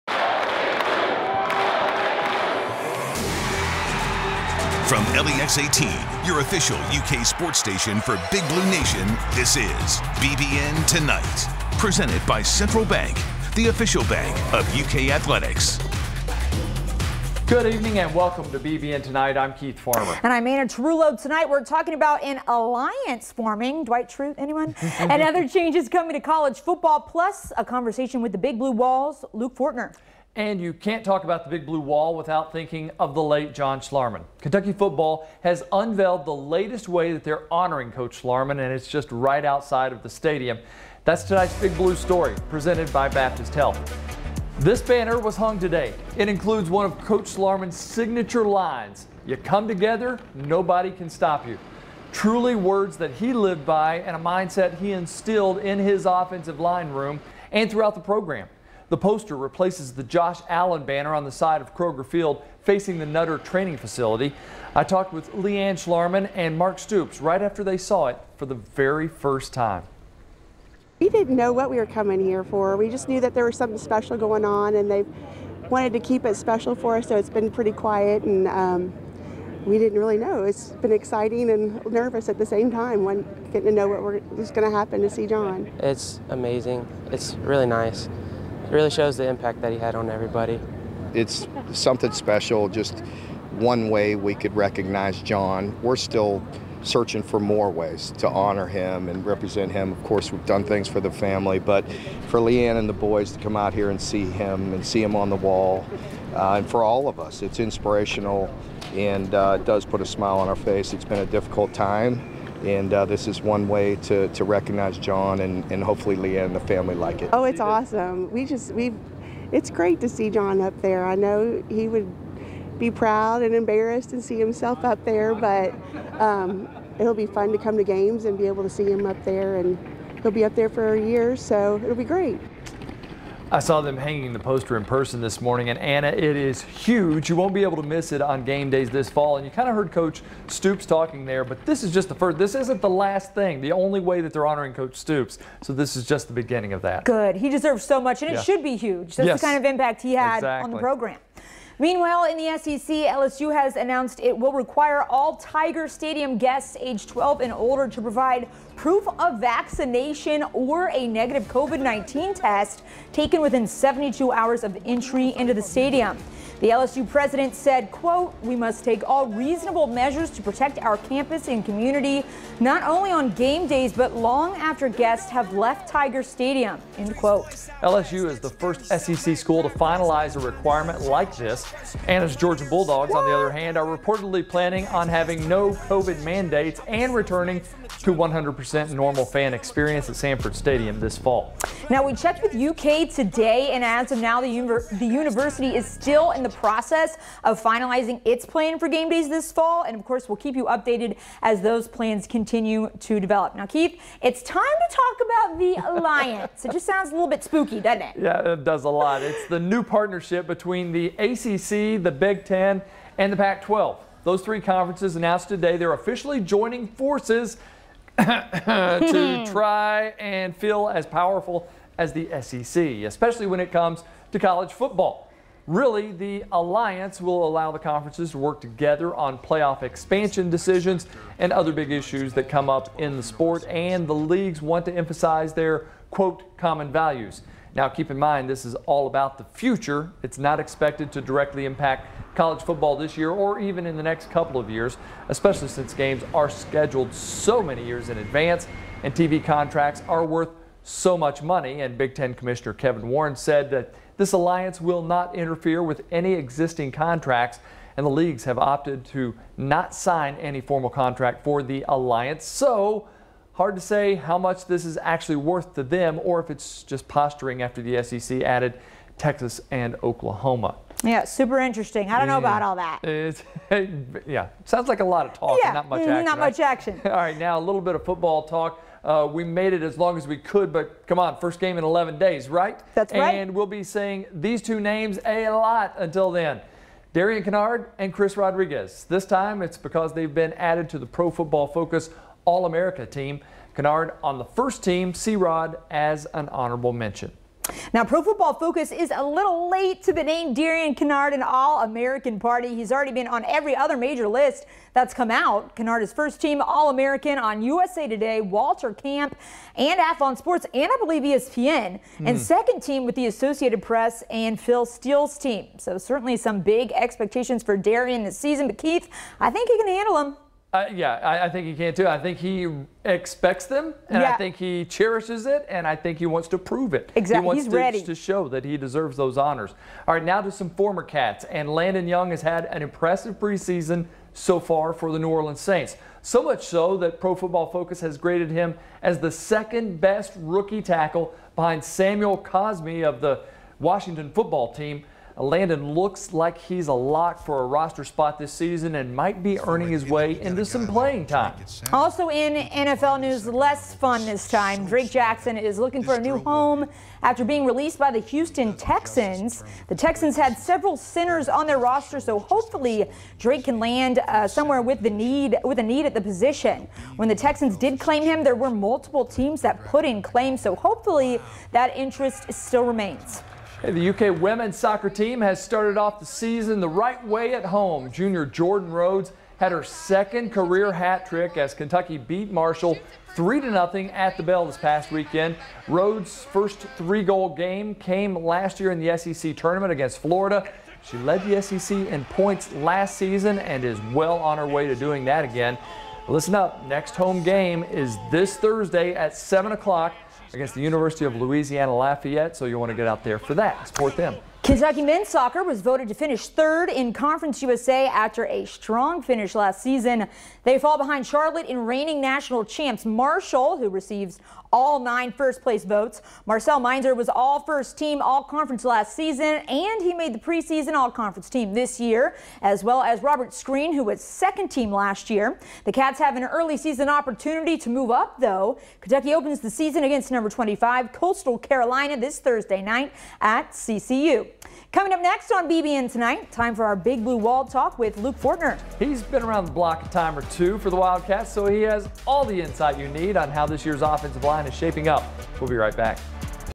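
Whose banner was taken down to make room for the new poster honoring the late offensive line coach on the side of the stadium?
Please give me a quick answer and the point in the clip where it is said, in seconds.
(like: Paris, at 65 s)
Josh Allen, at 60 s.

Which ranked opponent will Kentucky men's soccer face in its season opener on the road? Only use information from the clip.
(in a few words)
Coastal Carolina.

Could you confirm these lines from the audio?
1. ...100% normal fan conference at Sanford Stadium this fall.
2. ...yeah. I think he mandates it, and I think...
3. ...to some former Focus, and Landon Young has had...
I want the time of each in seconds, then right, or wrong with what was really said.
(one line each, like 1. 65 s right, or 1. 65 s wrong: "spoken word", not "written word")
1. 188 s wrong: "experience", not "conference"
2. 324 s wrong: "cherishes", not "mandates"
3. 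330 s wrong: "Cats", not "Focus".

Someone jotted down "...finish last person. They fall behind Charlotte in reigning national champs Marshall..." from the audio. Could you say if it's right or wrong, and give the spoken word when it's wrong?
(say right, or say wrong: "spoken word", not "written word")
wrong: "season", not "person".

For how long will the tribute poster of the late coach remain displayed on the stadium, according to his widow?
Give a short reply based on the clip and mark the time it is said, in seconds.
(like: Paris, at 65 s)
a year, at 130 s.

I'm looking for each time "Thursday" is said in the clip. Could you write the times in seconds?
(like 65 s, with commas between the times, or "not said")
398 s, 432 s.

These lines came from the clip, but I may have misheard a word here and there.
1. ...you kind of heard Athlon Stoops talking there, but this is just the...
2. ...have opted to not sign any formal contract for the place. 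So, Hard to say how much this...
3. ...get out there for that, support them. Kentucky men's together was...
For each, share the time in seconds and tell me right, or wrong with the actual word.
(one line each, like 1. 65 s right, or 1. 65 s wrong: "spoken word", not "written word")
1. 139 s wrong: "Coach", not "Athlon"
2. 258 s wrong: "alliance", not "place"
3. 402 s wrong: "soccer", not "together".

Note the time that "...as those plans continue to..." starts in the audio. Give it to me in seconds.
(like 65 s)
201 s.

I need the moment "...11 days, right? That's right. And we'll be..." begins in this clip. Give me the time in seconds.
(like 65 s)
281 s.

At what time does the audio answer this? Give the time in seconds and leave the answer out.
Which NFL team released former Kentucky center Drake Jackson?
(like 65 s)
358 s.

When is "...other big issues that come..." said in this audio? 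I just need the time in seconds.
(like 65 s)
231 s.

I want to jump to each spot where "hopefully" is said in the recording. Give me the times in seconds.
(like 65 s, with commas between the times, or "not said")
115 s, 362 s, 370 s.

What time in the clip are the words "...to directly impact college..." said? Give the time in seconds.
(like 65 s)
241 s.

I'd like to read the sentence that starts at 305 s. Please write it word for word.
Kinnard is first team All-American on USA Today, Walter Camp, and Athlon Sports, and I believe ESPN, mm.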